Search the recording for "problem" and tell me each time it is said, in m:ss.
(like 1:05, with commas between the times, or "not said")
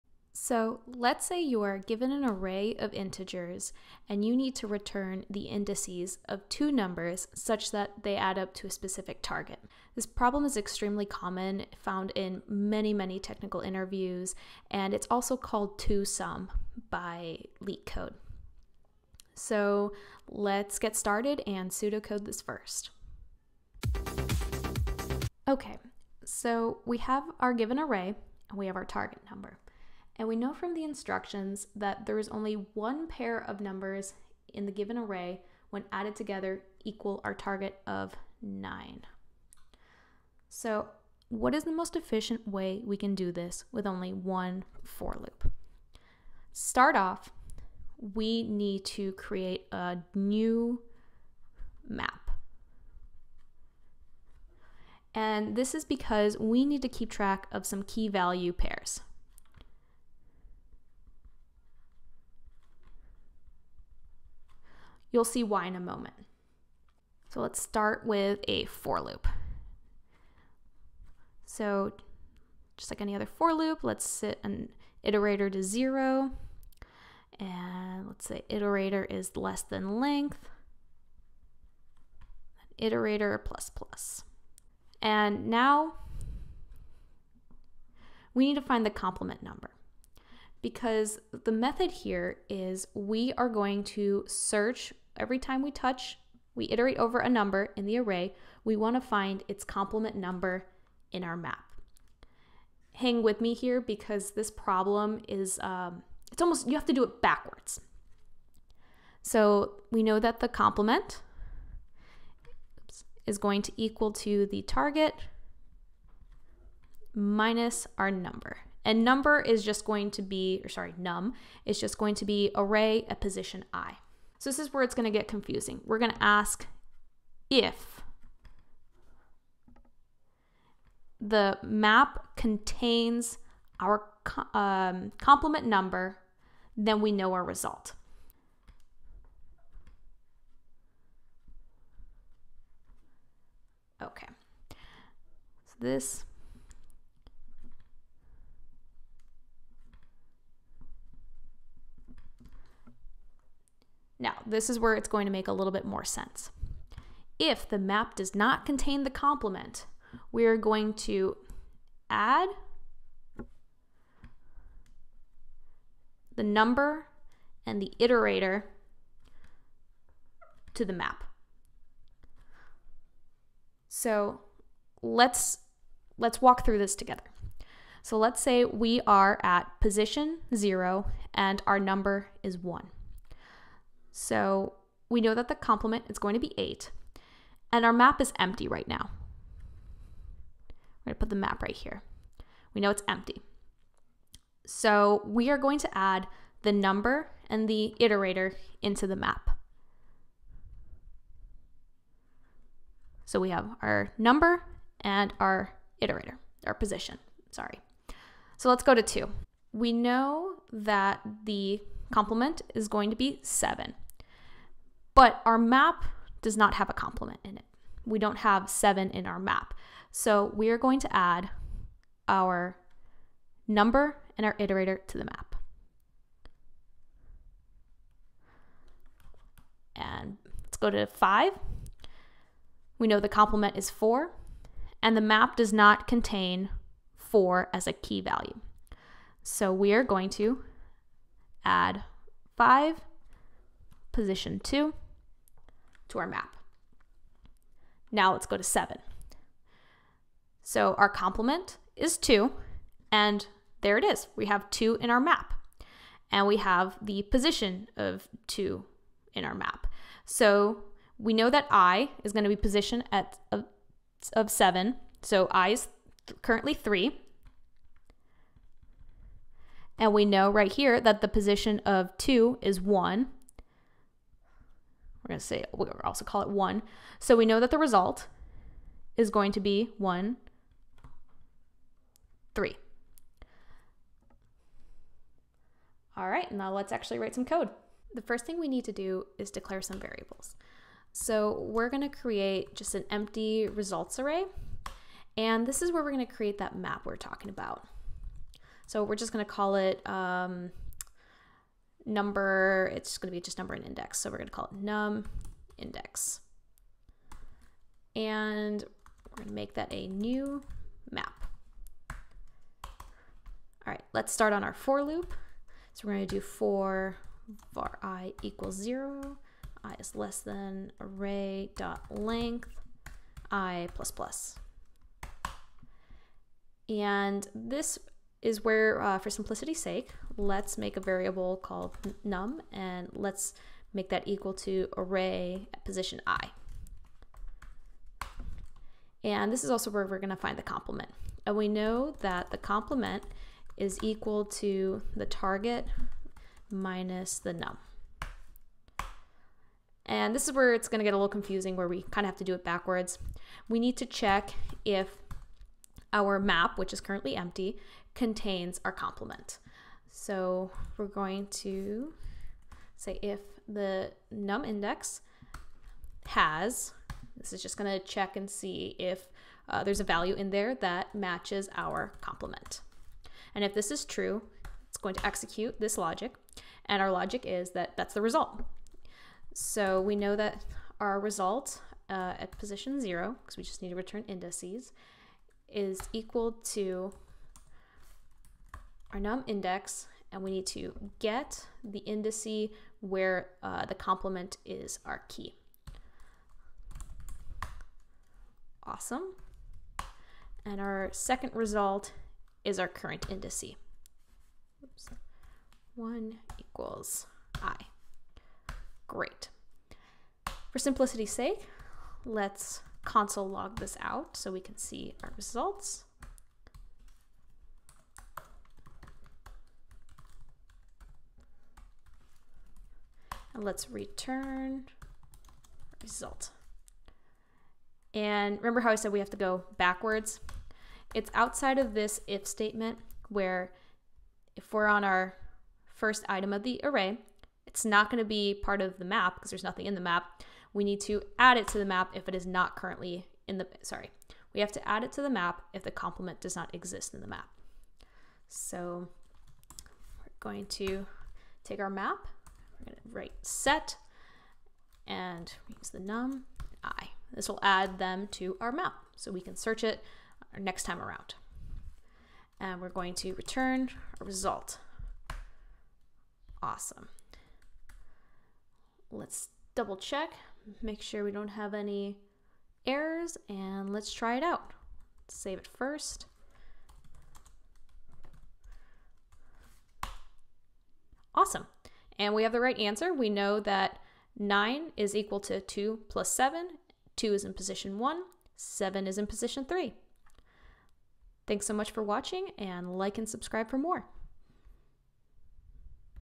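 0:10, 1:44.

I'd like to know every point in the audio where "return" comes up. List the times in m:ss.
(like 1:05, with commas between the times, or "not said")
0:04, 6:23, 7:03, 7:43.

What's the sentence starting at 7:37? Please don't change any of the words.
This will add them to our map so we can search it next time around.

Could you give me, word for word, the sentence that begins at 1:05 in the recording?
You'll see why in a moment.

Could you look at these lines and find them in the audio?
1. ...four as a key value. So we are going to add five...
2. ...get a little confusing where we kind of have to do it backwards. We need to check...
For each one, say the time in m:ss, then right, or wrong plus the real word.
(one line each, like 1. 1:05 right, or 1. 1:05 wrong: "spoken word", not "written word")
1. 3:57 right
2. 5:51 right.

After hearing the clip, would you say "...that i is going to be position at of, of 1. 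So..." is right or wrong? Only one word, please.
wrong.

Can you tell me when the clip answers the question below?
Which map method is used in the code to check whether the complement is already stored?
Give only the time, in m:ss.
6:06.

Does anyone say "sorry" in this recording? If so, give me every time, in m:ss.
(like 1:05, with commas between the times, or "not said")
2:00, 3:27, 7:23.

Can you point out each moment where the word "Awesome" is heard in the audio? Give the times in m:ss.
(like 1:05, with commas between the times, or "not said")
6:38, 7:46, 8:01.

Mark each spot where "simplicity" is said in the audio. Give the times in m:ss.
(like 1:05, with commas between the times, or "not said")
5:29, 6:50.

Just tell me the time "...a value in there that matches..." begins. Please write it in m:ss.
6:09.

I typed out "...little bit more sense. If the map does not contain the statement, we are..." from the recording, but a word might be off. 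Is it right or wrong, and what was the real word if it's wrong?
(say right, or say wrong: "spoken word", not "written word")
wrong: "complement", not "statement".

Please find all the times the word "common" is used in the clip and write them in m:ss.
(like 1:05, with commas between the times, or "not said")
0:11.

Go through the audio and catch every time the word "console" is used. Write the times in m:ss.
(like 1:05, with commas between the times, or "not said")
6:53.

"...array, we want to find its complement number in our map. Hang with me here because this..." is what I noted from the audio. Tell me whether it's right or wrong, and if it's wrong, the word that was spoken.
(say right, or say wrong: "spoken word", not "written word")
right.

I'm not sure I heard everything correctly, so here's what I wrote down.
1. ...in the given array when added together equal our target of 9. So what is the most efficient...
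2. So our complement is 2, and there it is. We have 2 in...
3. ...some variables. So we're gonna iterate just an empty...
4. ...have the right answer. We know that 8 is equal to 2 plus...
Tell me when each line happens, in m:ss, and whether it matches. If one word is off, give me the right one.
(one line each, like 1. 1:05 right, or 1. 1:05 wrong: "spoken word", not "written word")
1. 0:34 right
2. 4:10 right
3. 4:49 wrong: "create", not "iterate"
4. 8:02 wrong: "9", not "8".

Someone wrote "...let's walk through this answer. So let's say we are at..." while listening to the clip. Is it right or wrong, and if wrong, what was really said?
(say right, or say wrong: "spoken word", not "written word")
wrong: "together", not "answer".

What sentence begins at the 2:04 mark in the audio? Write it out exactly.
So this is where it's going to get confusing.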